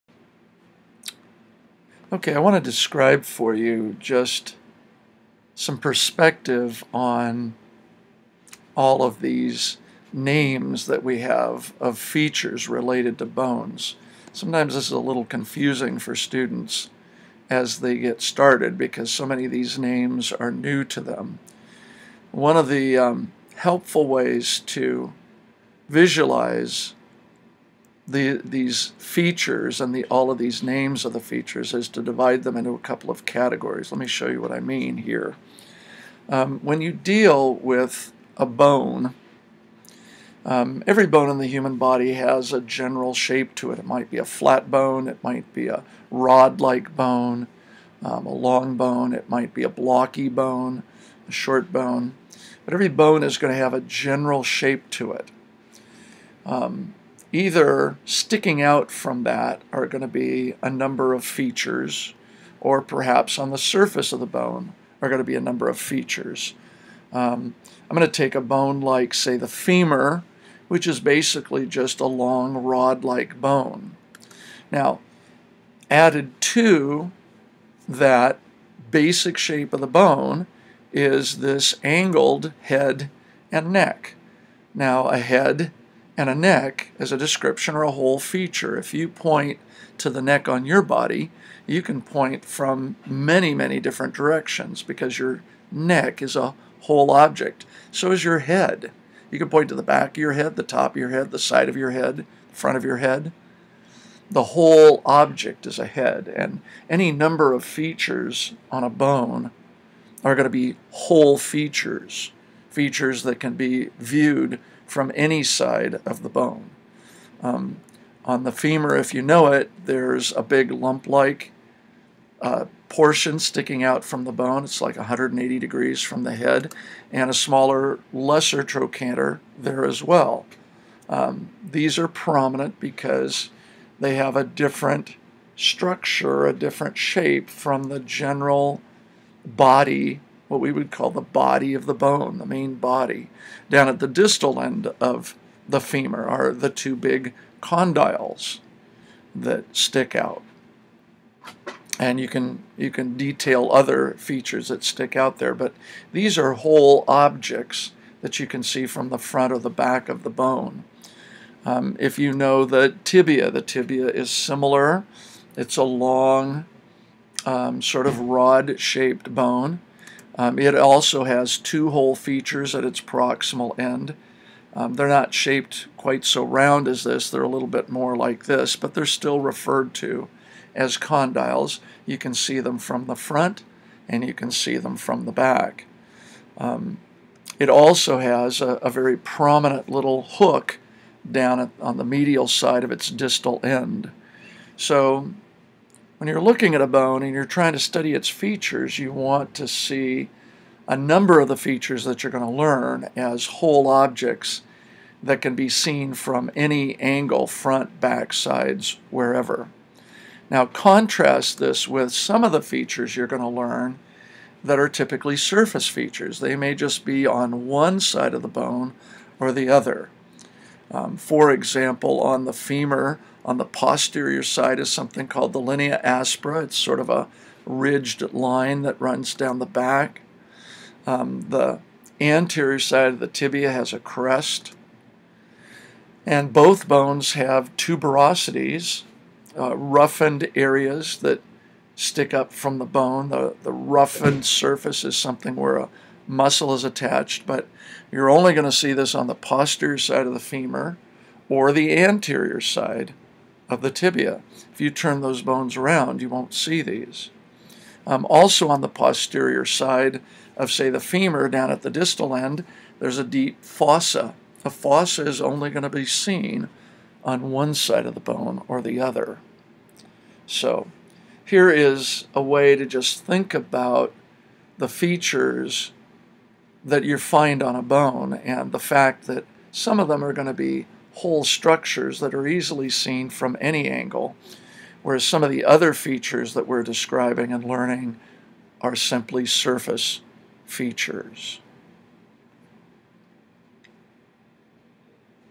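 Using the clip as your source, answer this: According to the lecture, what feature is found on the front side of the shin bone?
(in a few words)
a crest.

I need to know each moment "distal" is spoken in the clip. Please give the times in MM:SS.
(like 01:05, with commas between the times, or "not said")
02:24, 03:13, 04:21.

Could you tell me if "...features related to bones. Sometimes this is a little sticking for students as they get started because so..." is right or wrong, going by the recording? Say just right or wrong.
wrong.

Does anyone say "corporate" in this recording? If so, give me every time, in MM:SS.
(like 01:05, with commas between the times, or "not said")
not said.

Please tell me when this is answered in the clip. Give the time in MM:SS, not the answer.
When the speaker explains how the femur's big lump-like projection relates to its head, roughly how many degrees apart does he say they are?
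02:04.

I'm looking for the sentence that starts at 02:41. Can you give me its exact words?
Um, if you know the tibia, the tibia is similar.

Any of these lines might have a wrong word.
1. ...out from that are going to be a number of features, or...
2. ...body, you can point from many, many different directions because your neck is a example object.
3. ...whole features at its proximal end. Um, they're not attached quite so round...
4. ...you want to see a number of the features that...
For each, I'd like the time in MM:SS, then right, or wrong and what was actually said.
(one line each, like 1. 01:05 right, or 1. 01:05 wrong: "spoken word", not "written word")
1. 00:58 right
2. 01:30 wrong: "whole", not "example"
3. 02:51 wrong: "shaped", not "attached"
4. 03:18 right.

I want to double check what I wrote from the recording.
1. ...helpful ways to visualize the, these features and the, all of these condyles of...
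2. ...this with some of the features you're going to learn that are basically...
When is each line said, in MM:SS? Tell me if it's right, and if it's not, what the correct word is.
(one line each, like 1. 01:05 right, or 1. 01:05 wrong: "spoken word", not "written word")
1. 00:23 wrong: "names", not "condyles"
2. 03:31 wrong: "typically", not "basically".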